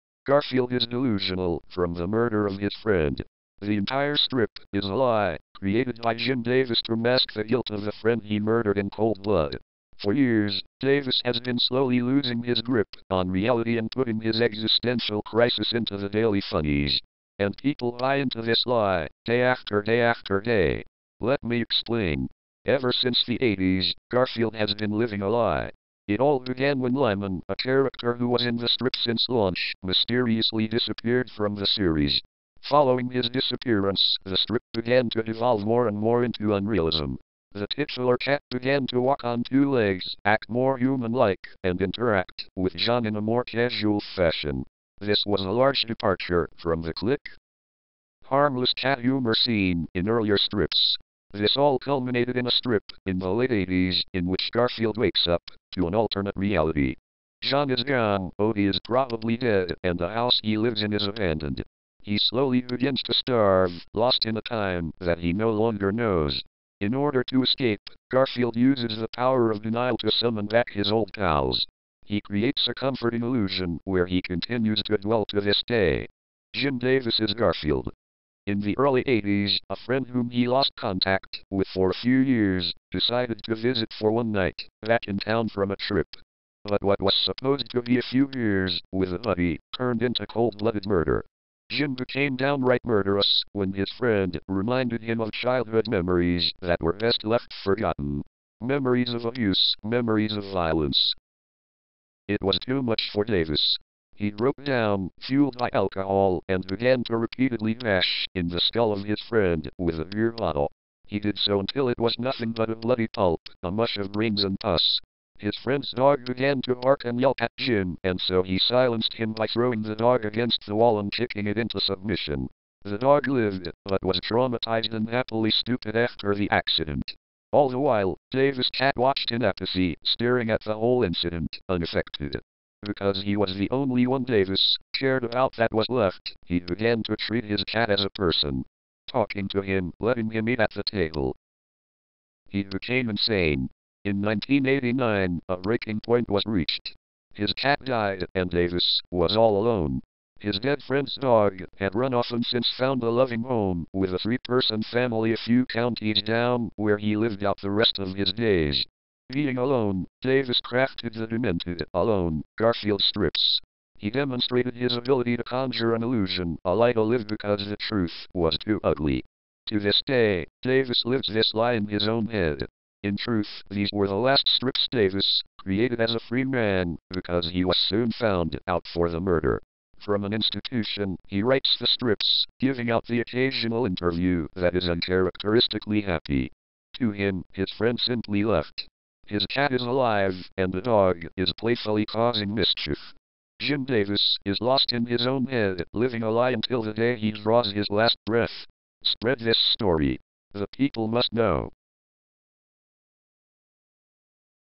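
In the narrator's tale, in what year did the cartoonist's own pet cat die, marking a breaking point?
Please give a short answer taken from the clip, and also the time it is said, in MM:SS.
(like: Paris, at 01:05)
1989, at 02:24.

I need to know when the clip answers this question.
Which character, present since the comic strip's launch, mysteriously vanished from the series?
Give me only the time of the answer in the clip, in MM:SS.
00:26.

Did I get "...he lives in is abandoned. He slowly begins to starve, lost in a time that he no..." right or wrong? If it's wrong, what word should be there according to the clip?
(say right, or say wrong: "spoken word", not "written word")
right.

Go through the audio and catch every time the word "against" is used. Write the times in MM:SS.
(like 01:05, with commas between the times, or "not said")
02:00.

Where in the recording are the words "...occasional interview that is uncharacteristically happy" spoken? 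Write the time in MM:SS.
03:03.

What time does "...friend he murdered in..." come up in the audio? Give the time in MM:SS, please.
00:07.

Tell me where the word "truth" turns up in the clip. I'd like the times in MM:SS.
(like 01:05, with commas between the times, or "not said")
02:47, 02:53.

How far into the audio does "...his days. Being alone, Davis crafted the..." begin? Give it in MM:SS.
02:38.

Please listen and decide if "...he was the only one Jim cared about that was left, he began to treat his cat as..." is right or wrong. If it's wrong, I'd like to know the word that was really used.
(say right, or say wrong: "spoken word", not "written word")
wrong: "Davis", not "Jim".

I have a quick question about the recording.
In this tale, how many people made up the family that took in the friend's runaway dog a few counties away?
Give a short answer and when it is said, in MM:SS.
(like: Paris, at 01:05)
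3, at 02:34.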